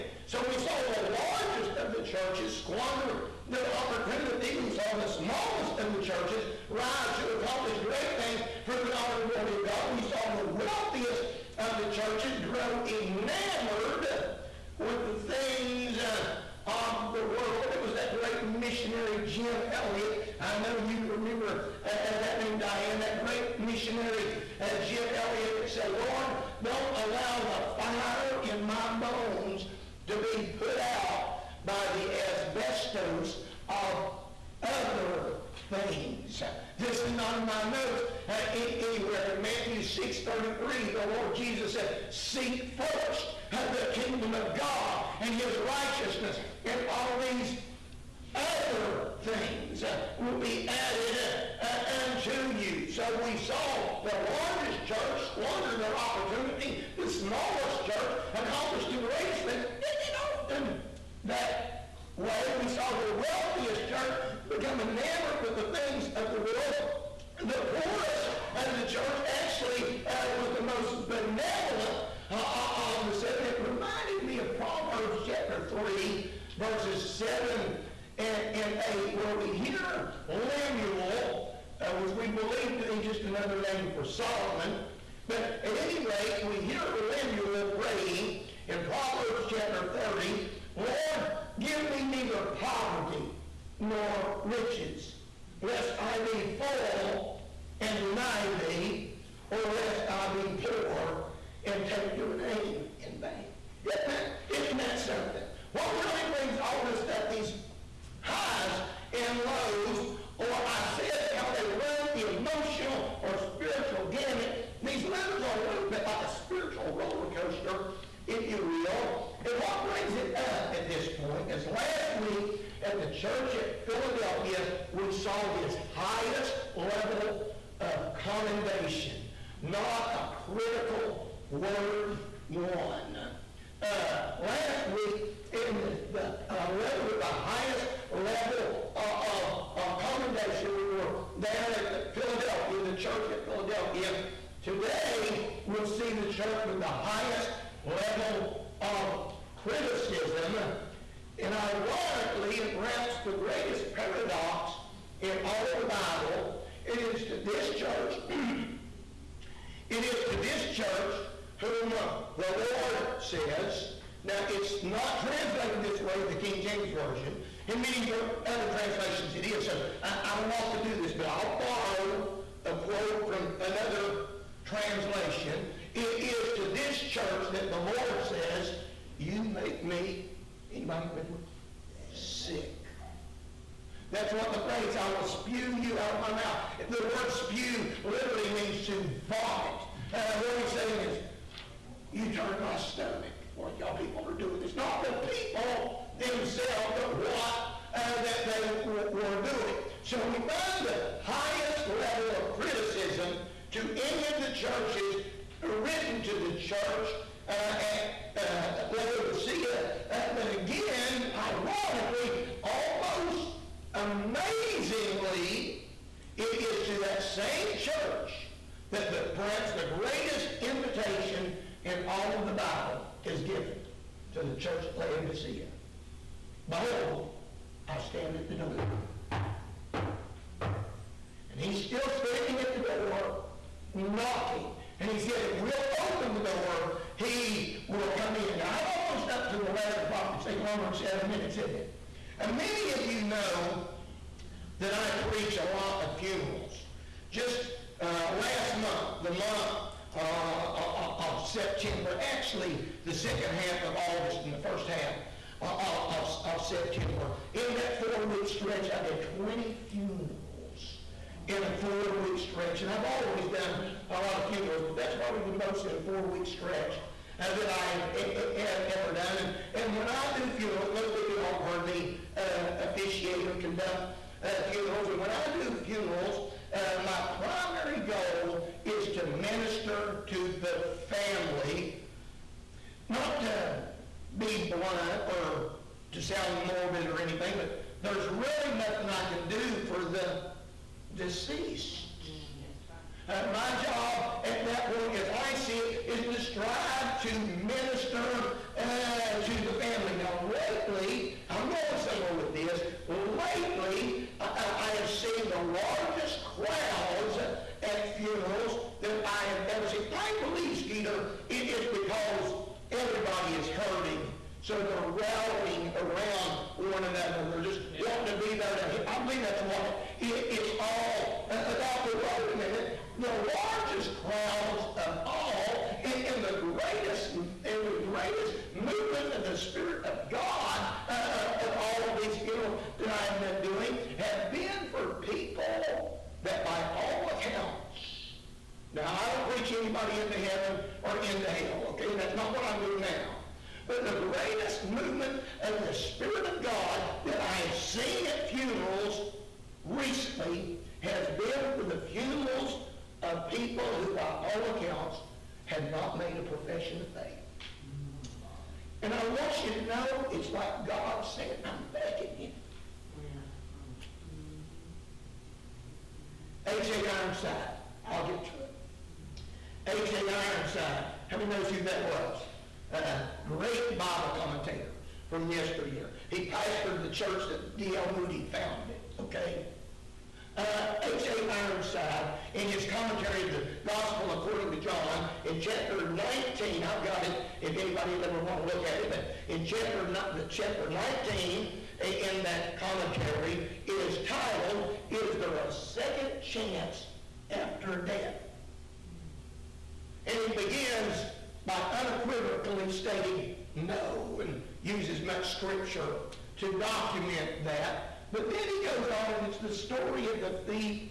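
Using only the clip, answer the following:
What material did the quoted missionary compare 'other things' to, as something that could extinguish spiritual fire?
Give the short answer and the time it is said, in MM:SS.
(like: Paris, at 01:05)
asbestos, at 00:32.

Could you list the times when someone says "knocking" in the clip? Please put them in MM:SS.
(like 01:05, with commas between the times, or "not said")
03:53.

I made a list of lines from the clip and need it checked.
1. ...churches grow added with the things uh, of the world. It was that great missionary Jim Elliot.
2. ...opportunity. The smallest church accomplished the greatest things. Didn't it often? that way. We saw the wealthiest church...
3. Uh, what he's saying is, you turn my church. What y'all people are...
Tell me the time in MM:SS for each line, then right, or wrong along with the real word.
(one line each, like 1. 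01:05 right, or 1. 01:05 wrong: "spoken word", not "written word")
1. 00:11 wrong: "enamored", not "added"
2. 00:55 right
3. 03:10 wrong: "stomach", not "church".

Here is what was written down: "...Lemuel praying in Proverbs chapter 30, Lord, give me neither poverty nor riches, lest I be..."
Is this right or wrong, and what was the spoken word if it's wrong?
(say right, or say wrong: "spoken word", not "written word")
right.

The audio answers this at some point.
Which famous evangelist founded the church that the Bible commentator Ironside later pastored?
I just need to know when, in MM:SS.
06:17.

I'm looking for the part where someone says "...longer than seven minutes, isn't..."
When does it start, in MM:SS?
04:00.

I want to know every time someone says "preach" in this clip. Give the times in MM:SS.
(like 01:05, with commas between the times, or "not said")
04:05, 05:39.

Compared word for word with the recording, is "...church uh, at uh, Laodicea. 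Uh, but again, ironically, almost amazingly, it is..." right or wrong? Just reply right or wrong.
right.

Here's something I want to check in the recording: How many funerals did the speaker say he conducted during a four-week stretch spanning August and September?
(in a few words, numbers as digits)
20.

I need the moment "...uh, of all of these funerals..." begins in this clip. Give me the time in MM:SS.
05:31.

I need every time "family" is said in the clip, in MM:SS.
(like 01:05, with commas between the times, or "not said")
04:41, 04:59.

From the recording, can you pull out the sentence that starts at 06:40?
And he begins by unequivocally stating no and uses much scripture to document that.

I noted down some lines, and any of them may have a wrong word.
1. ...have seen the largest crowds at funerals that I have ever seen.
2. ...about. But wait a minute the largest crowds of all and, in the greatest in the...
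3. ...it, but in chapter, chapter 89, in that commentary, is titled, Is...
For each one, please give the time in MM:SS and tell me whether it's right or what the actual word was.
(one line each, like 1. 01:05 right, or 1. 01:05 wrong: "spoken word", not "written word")
1. 05:04 right
2. 05:21 right
3. 06:28 wrong: "19", not "89".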